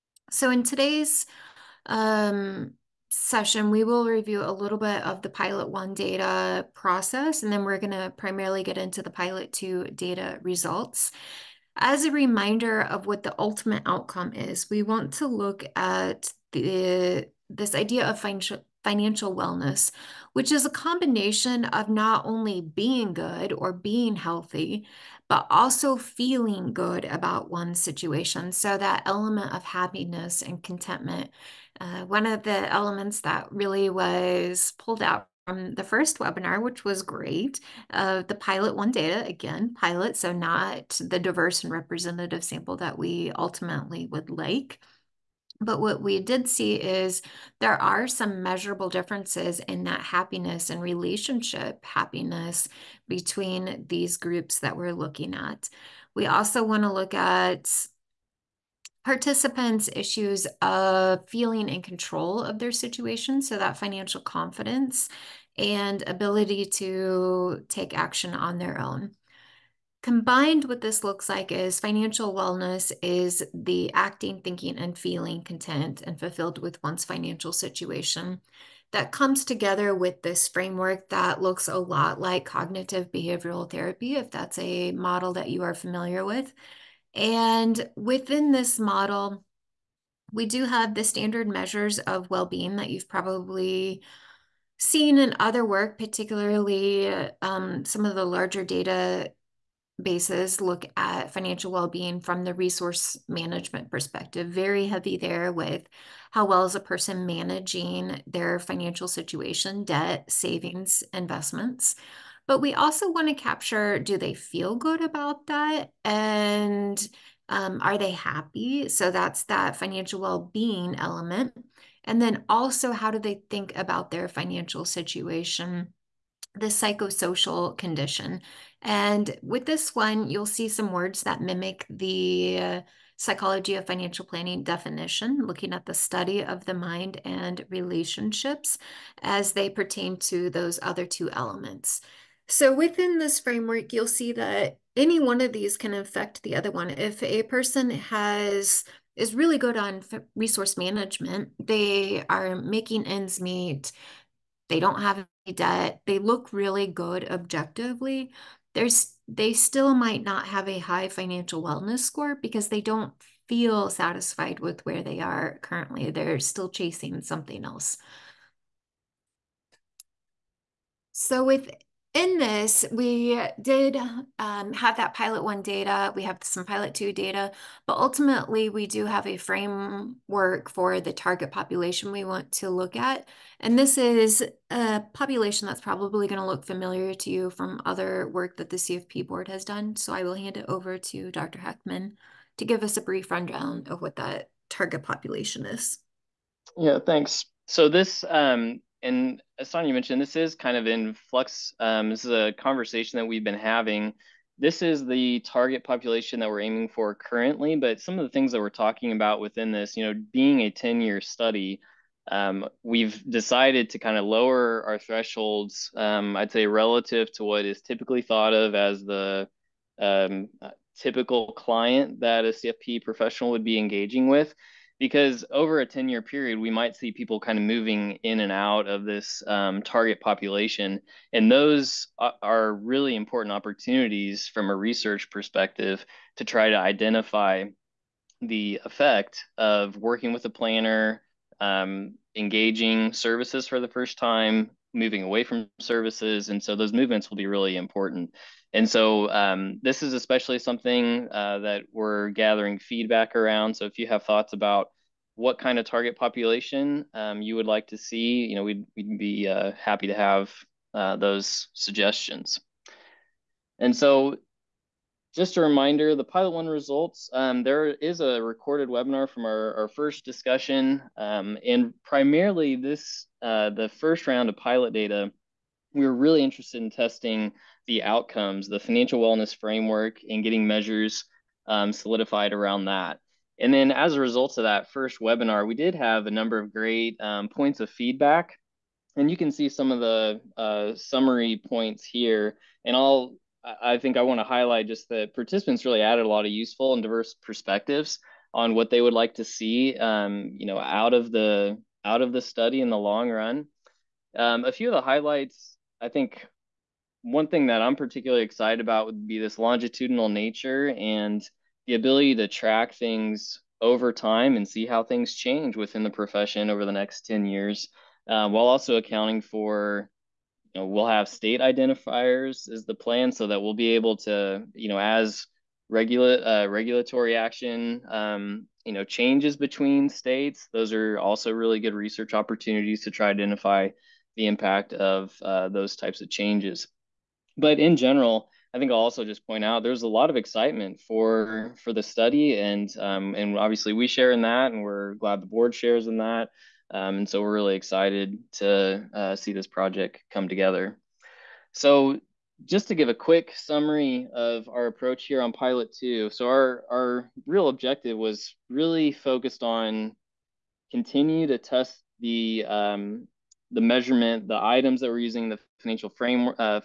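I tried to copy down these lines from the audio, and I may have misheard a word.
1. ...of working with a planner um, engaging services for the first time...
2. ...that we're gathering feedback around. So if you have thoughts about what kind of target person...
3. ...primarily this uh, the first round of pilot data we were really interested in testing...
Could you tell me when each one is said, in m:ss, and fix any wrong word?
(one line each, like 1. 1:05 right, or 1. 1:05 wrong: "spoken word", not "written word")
1. 3:59 right
2. 4:11 wrong: "population", not "person"
3. 4:32 right.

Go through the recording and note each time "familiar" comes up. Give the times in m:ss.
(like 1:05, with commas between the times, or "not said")
1:25, 3:06.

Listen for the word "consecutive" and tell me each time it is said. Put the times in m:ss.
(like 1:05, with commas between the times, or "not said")
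not said.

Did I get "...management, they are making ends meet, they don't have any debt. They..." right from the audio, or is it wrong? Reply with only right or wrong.
right.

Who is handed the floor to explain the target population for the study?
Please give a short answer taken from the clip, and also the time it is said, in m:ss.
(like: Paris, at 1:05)
Dr. Heckman, at 3:11.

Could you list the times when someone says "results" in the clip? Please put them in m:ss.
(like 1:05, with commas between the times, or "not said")
0:10, 4:26, 4:44.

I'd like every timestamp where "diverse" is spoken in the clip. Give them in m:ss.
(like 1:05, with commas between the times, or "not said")
0:41, 4:57.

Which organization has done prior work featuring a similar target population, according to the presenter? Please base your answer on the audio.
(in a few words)
CFP board.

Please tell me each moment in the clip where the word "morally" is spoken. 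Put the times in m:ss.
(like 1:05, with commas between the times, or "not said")
not said.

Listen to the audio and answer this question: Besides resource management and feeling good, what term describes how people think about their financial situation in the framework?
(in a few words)
psychosocial condition.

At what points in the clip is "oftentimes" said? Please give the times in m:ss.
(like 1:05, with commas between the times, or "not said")
not said.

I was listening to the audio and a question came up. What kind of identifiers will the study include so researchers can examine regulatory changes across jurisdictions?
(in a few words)
state identifiers.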